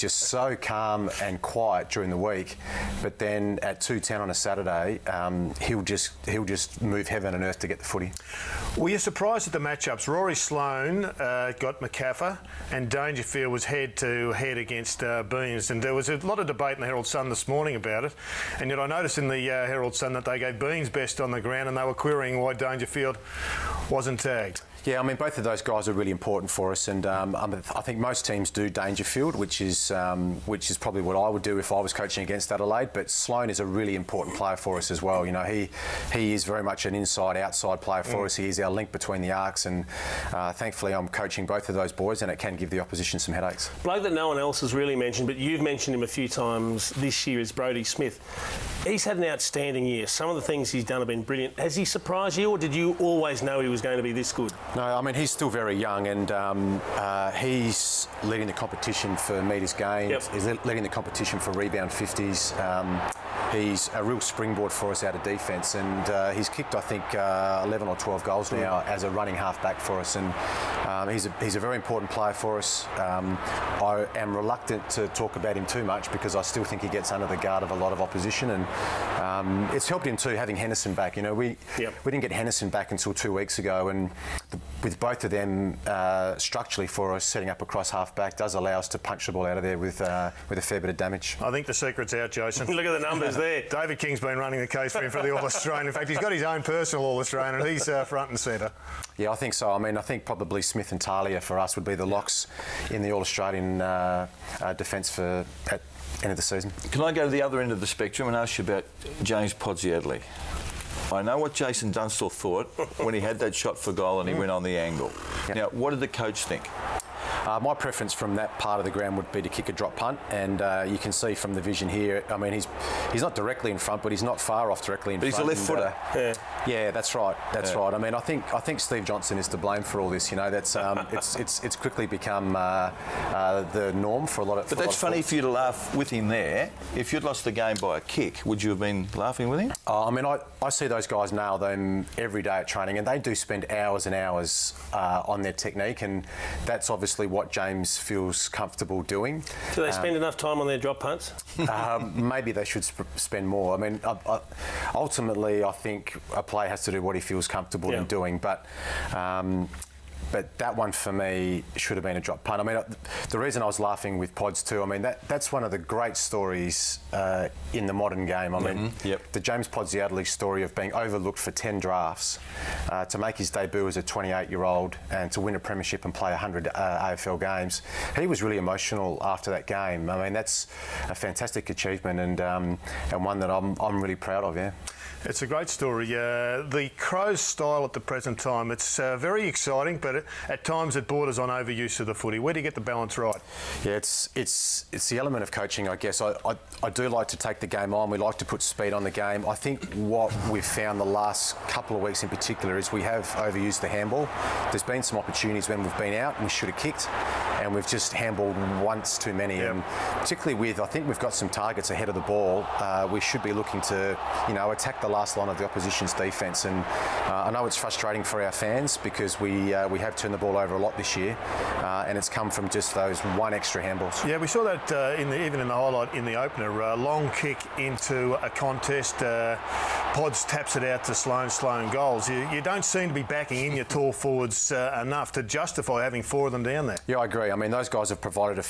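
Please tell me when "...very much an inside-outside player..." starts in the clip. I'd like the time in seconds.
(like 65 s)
36 s.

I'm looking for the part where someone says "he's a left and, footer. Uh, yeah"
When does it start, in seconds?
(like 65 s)
125 s.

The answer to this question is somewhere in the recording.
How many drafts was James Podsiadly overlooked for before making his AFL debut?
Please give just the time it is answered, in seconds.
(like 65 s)
171 s.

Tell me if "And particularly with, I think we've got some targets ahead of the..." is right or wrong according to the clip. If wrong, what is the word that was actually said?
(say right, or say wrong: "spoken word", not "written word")
right.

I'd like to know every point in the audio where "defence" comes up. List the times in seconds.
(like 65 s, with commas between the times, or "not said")
65 s, 104 s, 216 s.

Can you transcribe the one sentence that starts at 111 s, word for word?
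I know what Jason Dunstall thought when he had that shot for goal and he mm.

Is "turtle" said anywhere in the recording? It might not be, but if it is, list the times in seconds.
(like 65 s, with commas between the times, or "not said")
not said.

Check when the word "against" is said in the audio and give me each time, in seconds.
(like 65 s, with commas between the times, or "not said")
14 s, 32 s.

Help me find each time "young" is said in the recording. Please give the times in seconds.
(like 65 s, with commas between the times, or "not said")
55 s.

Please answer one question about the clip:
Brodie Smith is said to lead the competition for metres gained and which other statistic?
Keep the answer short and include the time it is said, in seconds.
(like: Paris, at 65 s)
Rebound 50s, at 61 s.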